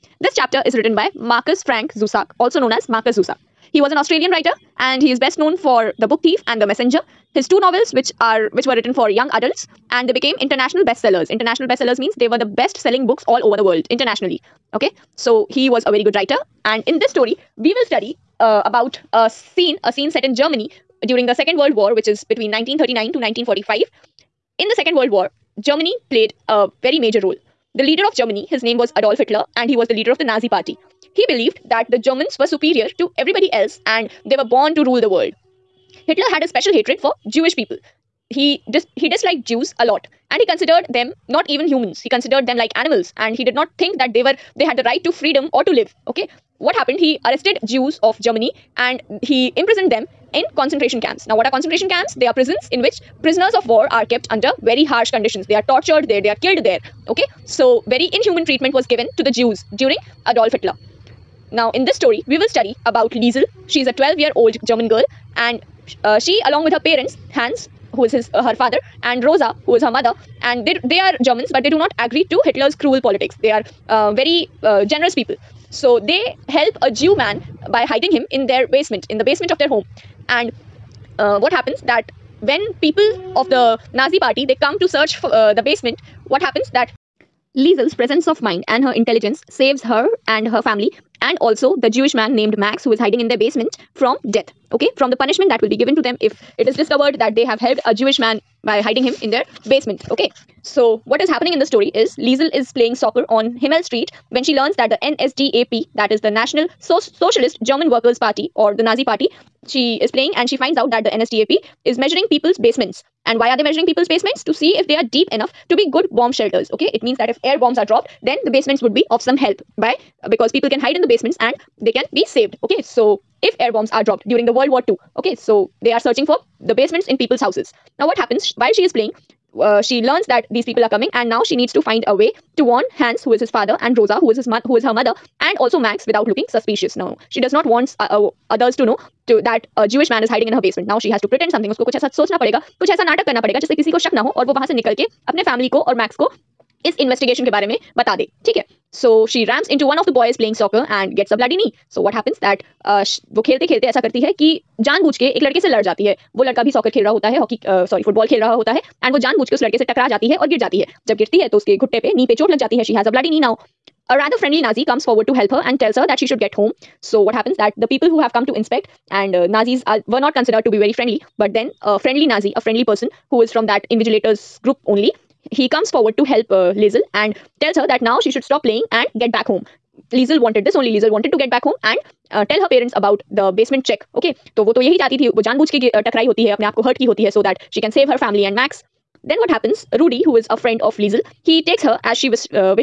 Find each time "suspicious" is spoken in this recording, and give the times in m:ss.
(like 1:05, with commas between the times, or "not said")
2:16.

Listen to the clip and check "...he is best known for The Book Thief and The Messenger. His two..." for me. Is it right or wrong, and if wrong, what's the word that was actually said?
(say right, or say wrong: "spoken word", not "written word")
right.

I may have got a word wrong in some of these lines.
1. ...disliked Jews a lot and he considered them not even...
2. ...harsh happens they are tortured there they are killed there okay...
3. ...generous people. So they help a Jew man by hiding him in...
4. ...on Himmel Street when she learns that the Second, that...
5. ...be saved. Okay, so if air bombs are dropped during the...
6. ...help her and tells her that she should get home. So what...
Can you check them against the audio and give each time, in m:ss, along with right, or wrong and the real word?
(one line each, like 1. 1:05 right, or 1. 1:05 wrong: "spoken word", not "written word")
1. 0:39 right
2. 0:54 wrong: "conditions", not "happens"
3. 1:14 right
4. 1:43 wrong: "NSDAP", not "Second"
5. 2:02 right
6. 2:45 right.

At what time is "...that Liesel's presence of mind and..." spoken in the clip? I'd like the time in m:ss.
1:26.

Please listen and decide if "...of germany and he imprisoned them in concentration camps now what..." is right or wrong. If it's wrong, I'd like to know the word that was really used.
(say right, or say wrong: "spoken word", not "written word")
right.